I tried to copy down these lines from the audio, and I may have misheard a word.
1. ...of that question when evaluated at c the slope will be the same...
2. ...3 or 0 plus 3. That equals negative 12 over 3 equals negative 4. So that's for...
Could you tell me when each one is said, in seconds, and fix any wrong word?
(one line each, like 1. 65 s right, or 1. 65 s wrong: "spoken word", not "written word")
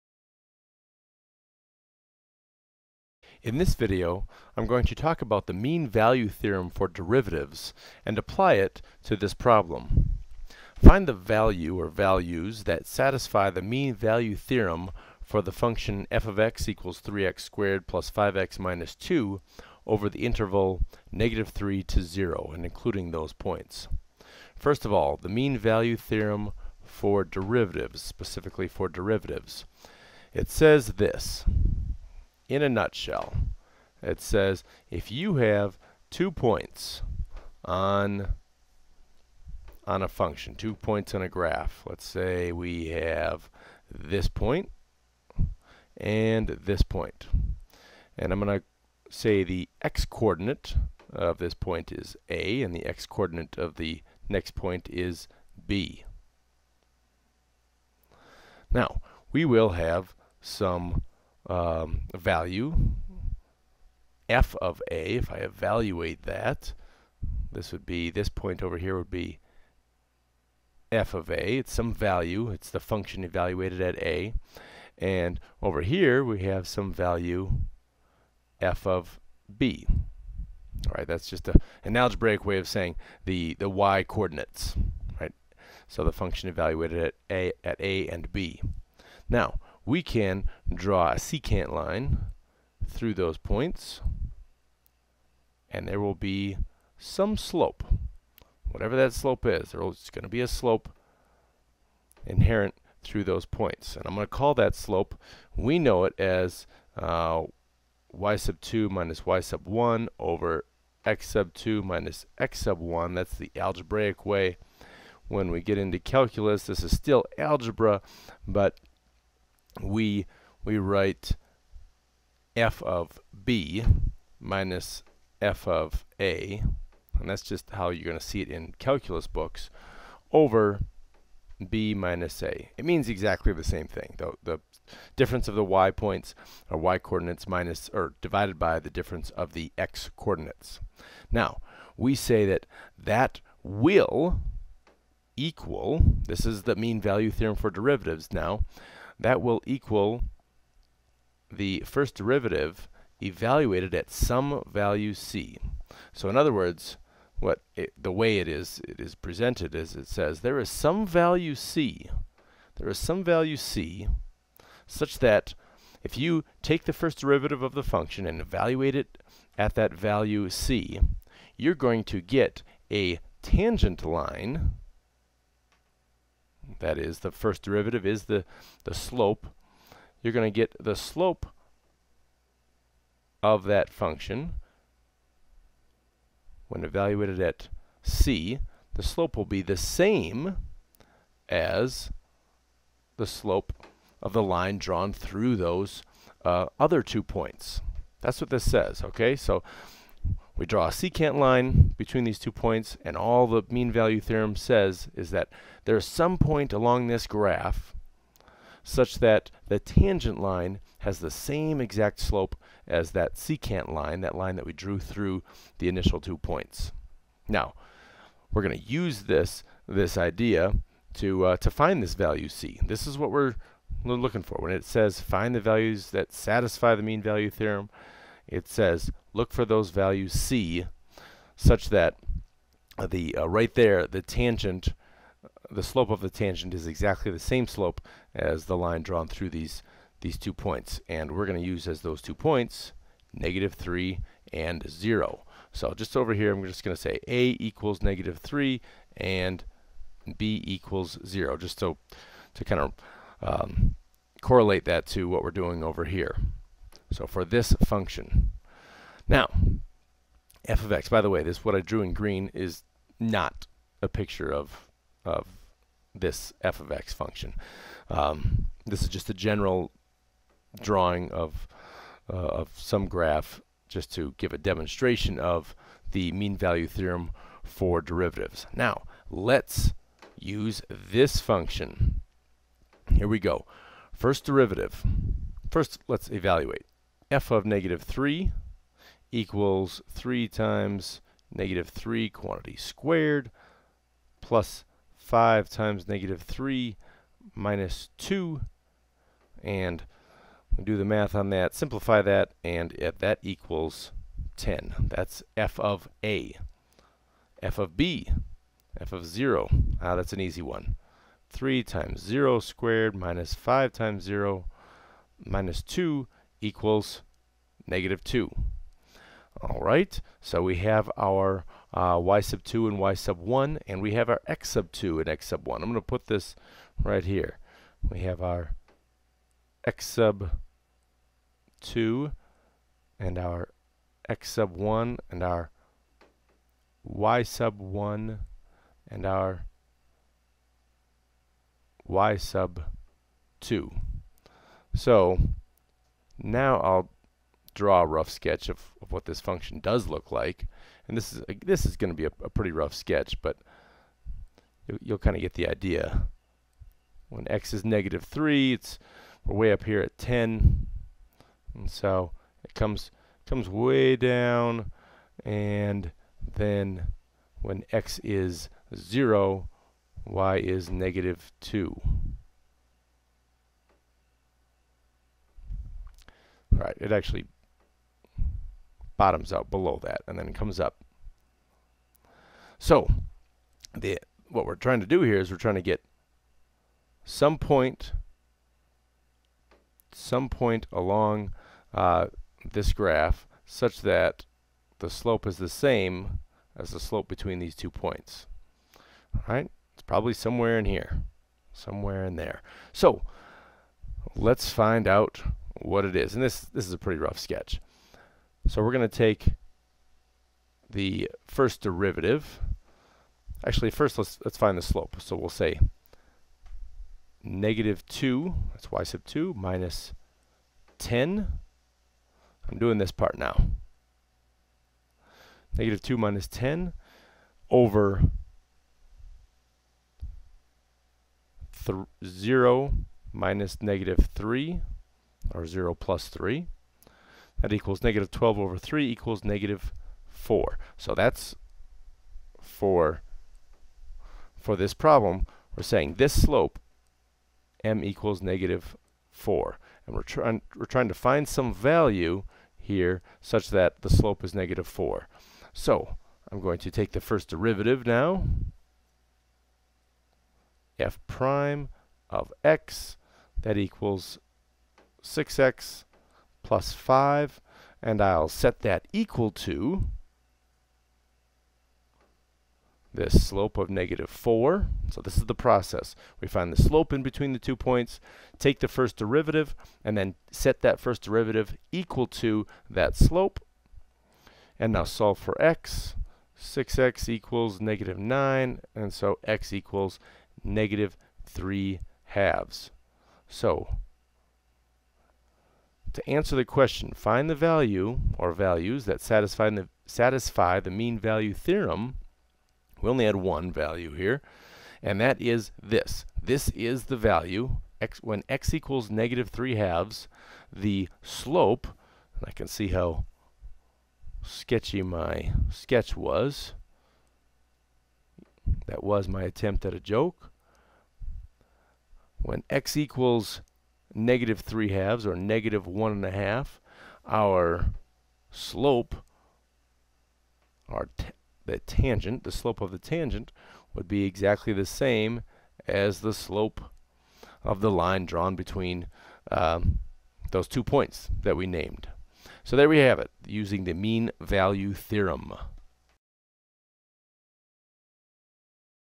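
1. 183 s wrong: "function", not "question"
2. 434 s right.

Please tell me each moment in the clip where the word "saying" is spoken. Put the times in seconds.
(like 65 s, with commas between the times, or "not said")
82 s, 445 s.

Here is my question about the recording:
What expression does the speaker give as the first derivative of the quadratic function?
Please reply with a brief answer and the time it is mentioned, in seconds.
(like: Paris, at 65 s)
6x + 5, at 465 s.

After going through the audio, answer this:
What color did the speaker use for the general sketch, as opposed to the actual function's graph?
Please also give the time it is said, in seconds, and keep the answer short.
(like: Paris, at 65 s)
green, at 262 s.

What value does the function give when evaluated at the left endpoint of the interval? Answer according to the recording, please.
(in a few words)
10.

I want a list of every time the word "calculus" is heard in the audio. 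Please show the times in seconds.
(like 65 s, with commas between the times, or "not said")
115 s, 128 s.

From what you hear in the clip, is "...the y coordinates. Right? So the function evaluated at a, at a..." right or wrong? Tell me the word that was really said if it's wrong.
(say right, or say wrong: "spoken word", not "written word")
right.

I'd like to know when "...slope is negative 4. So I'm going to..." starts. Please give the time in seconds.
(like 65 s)
454 s.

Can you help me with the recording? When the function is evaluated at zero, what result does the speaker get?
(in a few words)
-2.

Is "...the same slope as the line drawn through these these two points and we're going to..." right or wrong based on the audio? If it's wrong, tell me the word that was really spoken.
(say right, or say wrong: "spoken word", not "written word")
right.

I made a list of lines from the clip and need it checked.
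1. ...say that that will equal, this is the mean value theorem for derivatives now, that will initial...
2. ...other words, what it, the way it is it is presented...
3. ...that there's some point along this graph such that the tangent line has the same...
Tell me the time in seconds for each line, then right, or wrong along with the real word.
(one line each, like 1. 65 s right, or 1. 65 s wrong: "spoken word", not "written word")
1. 142 s wrong: "equal", not "initial"
2. 156 s right
3. 205 s right.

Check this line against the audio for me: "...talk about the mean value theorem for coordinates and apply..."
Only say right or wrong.
wrong.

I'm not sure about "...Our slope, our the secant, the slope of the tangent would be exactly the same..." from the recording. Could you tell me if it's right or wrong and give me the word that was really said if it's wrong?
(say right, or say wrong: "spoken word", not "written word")
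wrong: "tangent", not "secant".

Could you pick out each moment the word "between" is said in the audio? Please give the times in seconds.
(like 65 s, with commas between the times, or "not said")
201 s, 397 s, 477 s, 538 s.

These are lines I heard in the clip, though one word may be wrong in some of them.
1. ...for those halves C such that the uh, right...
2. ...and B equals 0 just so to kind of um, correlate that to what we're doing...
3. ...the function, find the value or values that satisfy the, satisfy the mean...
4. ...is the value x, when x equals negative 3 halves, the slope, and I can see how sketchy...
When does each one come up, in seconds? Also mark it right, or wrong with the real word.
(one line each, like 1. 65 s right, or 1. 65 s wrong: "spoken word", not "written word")
1. 229 s wrong: "values", not "halves"
2. 249 s right
3. 496 s wrong: "question", not "function"
4. 506 s right.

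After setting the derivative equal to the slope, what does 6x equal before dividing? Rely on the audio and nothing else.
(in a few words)
-9.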